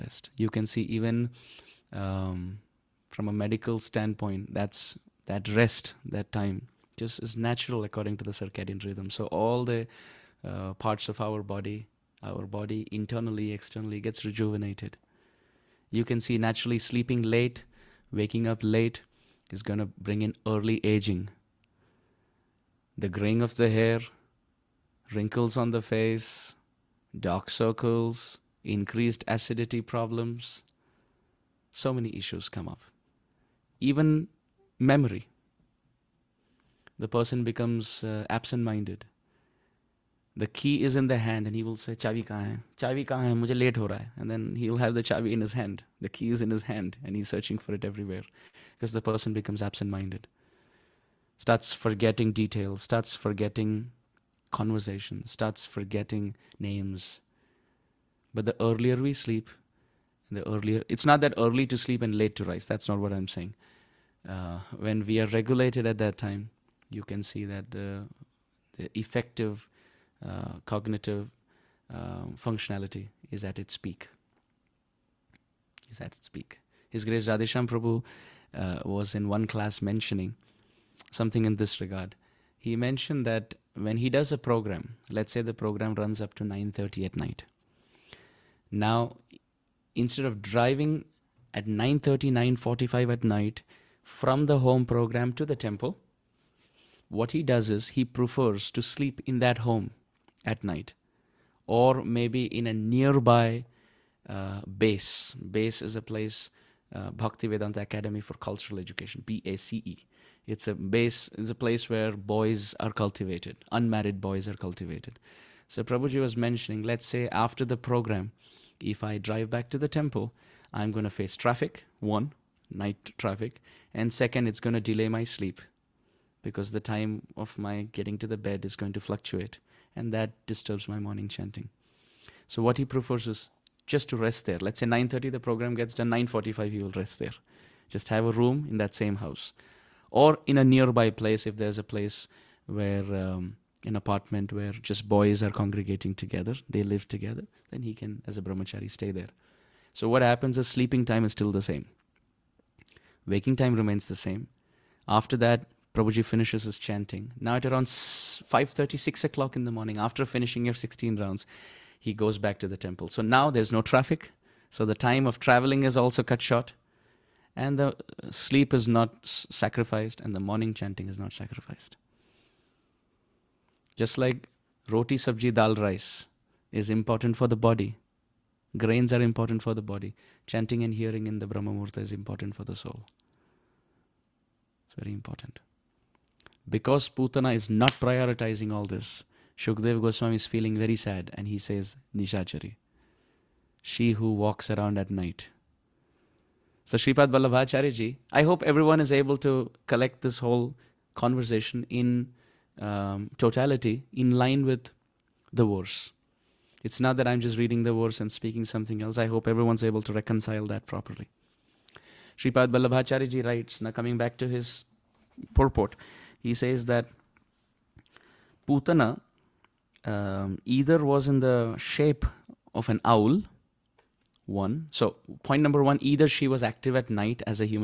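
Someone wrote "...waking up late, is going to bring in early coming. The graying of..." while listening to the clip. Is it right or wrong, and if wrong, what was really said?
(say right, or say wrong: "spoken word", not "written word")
wrong: "aging", not "coming".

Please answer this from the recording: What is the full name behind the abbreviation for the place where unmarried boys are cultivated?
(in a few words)
Bhakti Vedanta Academy for Cultural Education.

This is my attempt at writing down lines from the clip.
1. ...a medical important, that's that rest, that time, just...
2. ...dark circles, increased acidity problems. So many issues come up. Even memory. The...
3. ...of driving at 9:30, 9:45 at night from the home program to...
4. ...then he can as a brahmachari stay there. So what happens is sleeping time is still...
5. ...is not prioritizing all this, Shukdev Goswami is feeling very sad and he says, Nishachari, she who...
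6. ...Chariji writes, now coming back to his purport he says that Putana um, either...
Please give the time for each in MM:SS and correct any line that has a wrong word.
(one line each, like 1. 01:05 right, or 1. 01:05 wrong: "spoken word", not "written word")
1. 00:03 wrong: "standpoint", not "important"
2. 00:27 right
3. 01:30 right
4. 02:27 right
5. 03:07 right
6. 03:33 right.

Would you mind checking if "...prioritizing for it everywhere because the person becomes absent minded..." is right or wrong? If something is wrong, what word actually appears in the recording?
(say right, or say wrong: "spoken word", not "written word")
wrong: "searching", not "prioritizing".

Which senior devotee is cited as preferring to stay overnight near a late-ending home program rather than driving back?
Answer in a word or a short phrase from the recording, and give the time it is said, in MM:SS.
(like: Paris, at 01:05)
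Radheshyam Prabhu, at 01:17.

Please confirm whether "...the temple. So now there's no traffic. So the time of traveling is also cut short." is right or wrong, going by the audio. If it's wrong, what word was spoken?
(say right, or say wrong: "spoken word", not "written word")
right.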